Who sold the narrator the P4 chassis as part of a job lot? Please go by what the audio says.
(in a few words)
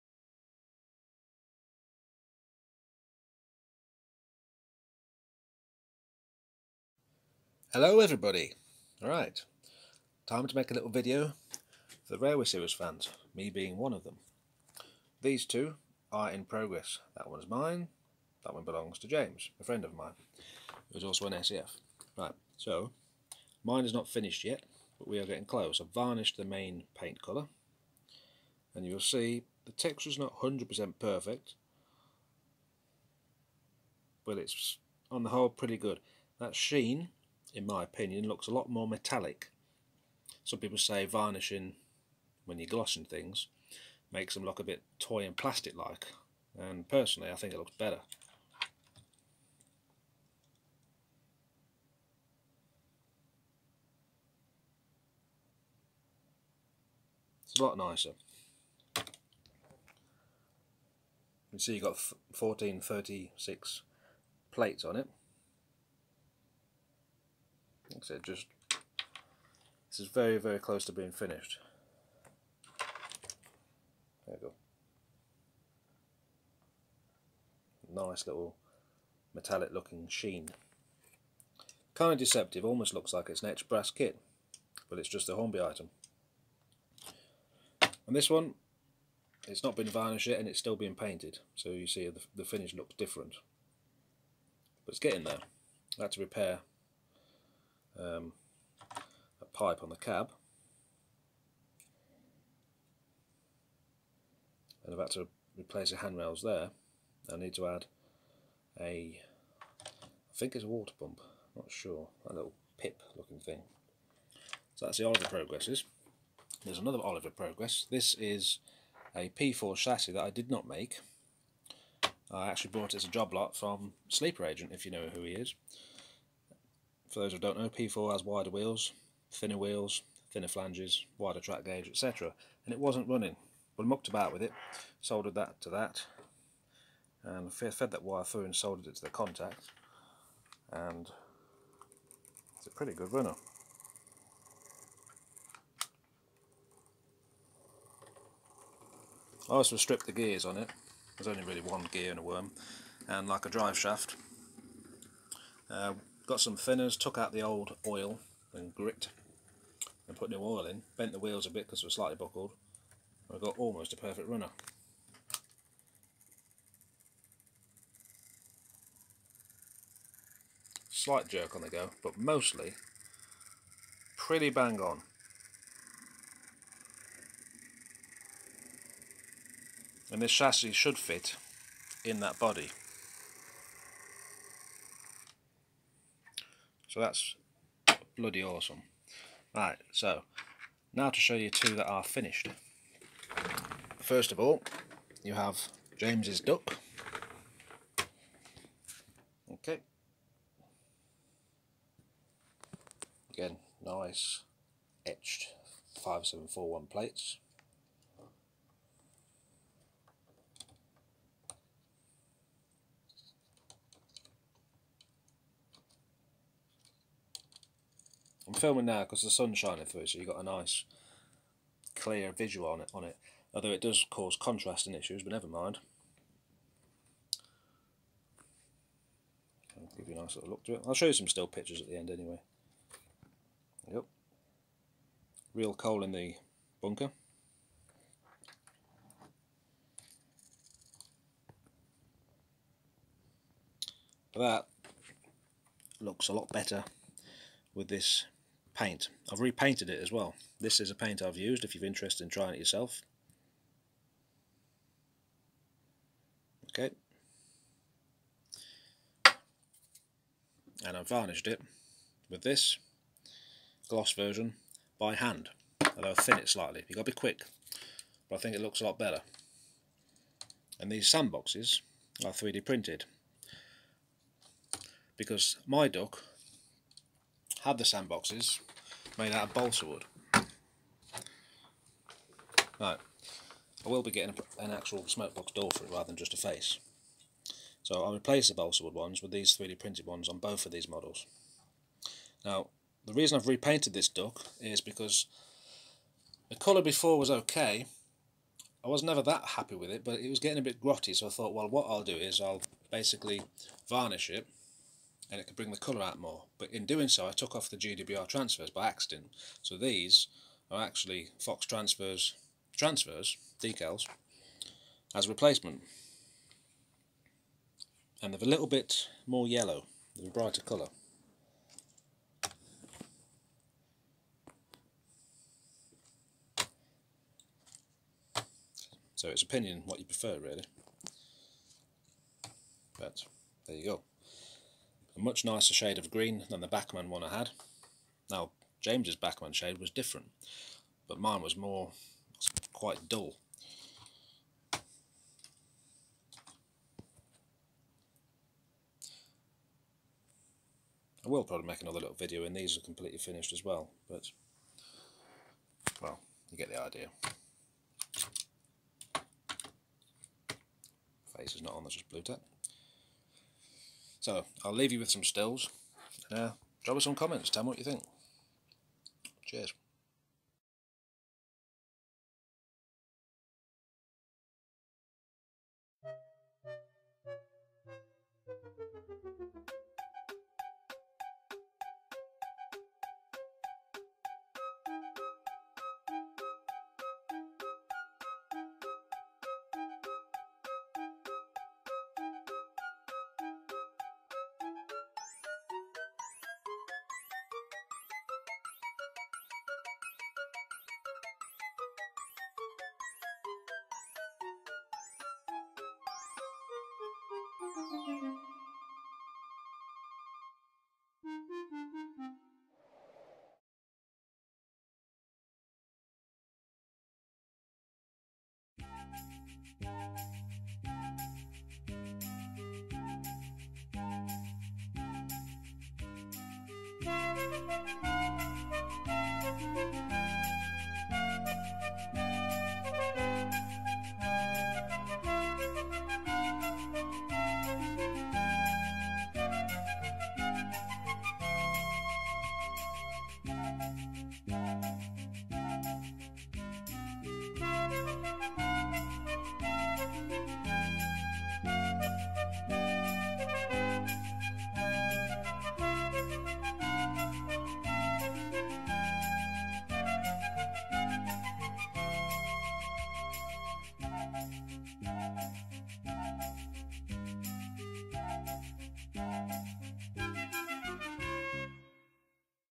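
Sleeper Agent.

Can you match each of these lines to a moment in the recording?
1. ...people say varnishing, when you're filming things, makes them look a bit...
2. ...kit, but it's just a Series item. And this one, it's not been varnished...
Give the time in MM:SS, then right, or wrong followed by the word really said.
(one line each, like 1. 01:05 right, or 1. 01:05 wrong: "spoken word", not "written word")
1. 00:40 wrong: "glossing", not "filming"
2. 01:23 wrong: "Hornby", not "Series".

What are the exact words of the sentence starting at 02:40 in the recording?
Bent the wheels a bit because they were slightly buckled.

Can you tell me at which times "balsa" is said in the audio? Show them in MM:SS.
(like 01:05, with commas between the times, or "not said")
04:39, 04:48.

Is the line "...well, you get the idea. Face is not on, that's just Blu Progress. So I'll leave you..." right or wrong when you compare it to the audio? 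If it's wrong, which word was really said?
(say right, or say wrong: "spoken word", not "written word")
wrong: "Tack", not "Progress".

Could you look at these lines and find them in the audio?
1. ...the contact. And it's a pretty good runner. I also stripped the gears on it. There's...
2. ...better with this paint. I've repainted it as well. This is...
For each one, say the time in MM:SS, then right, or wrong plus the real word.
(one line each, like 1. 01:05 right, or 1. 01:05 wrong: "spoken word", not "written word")
1. 02:19 right
2. 04:06 right.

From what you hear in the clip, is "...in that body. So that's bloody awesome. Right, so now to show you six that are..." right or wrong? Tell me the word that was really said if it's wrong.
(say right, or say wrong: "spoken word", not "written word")
wrong: "two", not "six".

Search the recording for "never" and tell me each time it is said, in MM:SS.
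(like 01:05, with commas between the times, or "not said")
03:45, 04:59.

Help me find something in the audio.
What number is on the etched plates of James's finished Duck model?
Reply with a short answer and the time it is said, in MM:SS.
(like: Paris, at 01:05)
5741, at 03:26.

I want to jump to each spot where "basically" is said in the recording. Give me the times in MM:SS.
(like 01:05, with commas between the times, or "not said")
05:02.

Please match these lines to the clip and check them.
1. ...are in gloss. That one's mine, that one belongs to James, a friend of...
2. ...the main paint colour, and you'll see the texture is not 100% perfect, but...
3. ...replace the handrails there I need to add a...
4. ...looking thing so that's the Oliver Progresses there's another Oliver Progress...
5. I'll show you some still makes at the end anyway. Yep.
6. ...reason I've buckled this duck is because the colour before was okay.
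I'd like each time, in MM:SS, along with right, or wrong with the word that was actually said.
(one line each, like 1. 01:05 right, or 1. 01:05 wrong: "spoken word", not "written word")
1. 00:16 wrong: "progress", not "gloss"
2. 00:26 right
3. 01:45 right
4. 01:53 right
5. 03:50 wrong: "pictures", not "makes"
6. 04:53 wrong: "repainted", not "buckled".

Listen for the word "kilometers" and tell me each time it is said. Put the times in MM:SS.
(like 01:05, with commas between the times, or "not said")
not said.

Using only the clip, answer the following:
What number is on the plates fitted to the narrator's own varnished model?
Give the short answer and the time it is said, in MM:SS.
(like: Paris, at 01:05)
1436, at 01:02.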